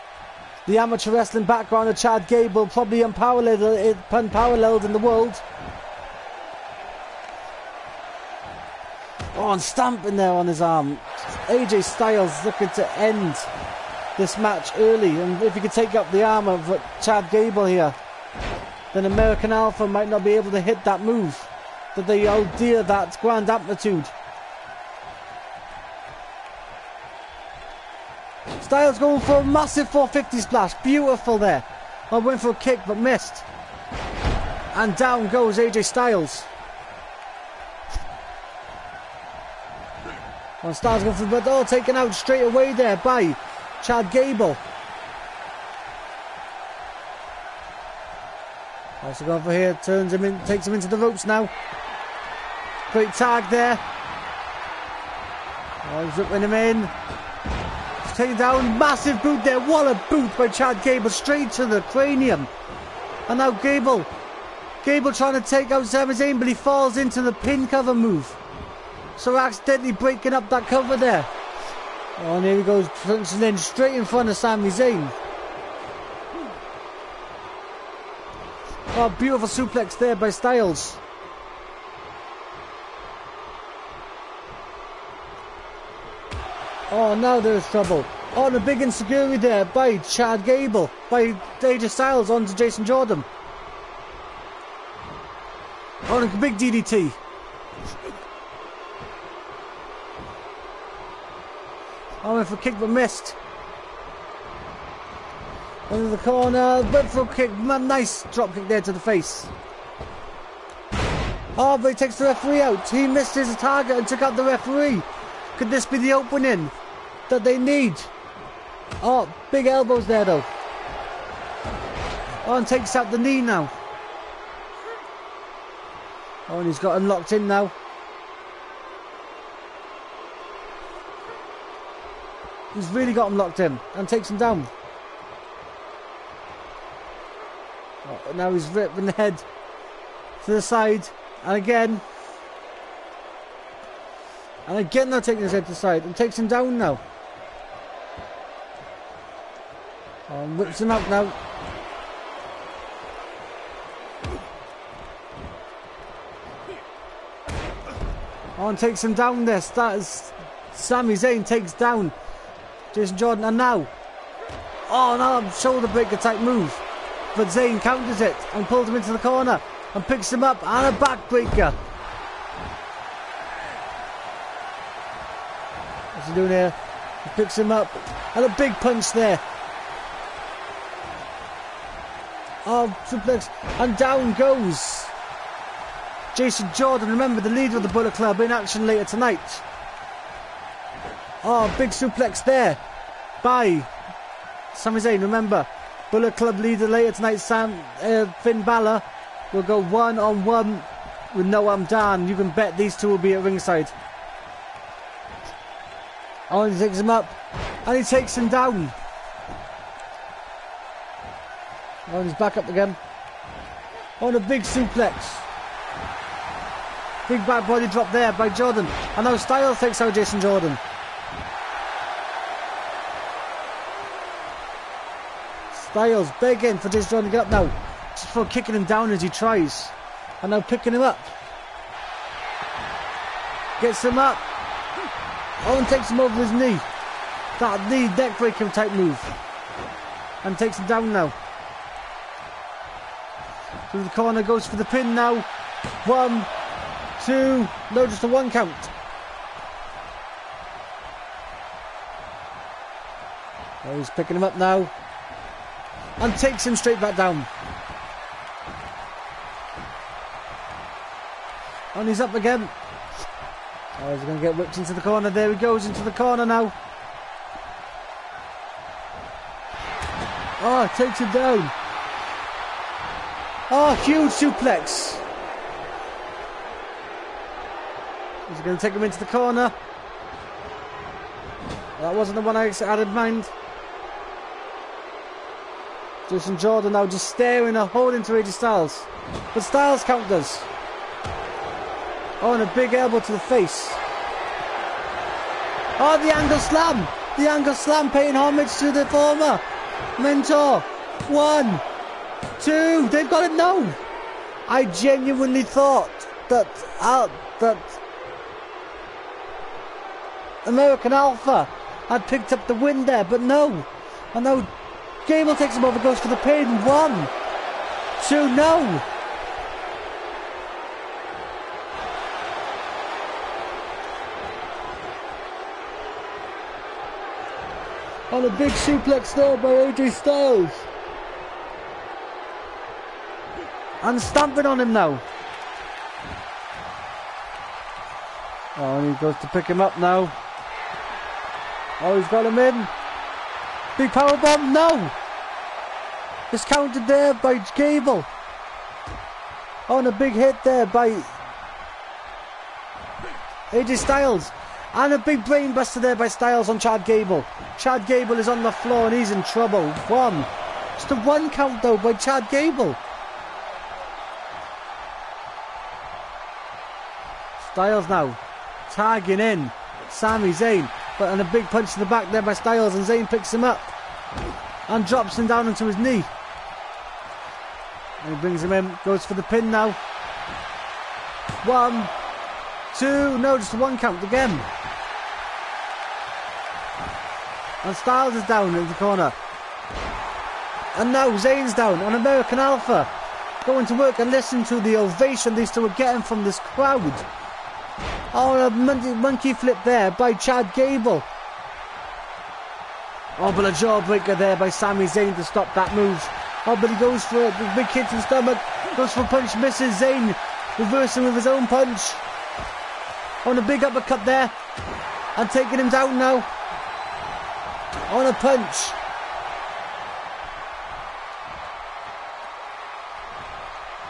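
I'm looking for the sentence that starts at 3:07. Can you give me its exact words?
Remember the leader of the Bullet Club in action later tonight.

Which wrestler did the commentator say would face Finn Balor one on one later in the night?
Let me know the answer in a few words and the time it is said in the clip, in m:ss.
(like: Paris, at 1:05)
Noam Dar, at 3:21.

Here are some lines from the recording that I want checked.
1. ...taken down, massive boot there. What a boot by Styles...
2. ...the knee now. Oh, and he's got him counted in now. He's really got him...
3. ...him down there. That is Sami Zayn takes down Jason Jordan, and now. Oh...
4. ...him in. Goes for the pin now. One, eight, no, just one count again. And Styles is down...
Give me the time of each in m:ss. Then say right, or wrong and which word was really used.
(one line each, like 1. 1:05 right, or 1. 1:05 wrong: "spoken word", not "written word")
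1. 0:58 wrong: "Chad", not "Styles"
2. 2:03 wrong: "locked", not "counted"
3. 2:39 right
4. 6:18 wrong: "two", not "eight".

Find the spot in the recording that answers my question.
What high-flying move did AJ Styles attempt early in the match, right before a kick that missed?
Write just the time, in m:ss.
0:29.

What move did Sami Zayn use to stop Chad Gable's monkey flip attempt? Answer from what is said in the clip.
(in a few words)
Jawbreaker.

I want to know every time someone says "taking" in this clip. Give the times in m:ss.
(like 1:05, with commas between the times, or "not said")
2:25, 6:55.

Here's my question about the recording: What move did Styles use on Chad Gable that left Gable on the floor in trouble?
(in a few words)
Brainbuster.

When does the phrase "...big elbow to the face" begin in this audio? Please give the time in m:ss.
4:52.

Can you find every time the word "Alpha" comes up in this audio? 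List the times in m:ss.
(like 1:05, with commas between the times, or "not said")
0:19, 5:11, 6:32.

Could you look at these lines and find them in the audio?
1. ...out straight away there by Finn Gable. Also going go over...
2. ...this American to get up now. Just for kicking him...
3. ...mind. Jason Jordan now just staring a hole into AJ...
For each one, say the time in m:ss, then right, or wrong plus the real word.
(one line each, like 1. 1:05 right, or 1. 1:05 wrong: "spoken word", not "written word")
1. 0:41 wrong: "Chad", not "Finn"
2. 3:46 wrong: "Jordan", not "American"
3. 4:43 right.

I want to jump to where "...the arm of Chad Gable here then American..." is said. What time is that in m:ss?
0:16.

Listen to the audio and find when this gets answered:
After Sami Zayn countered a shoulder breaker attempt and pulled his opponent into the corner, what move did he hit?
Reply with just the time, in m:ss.
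2:50.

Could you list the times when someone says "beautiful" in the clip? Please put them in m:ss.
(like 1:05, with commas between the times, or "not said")
0:30, 1:19.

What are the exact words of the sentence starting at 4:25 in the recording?
There he goes into the corner now.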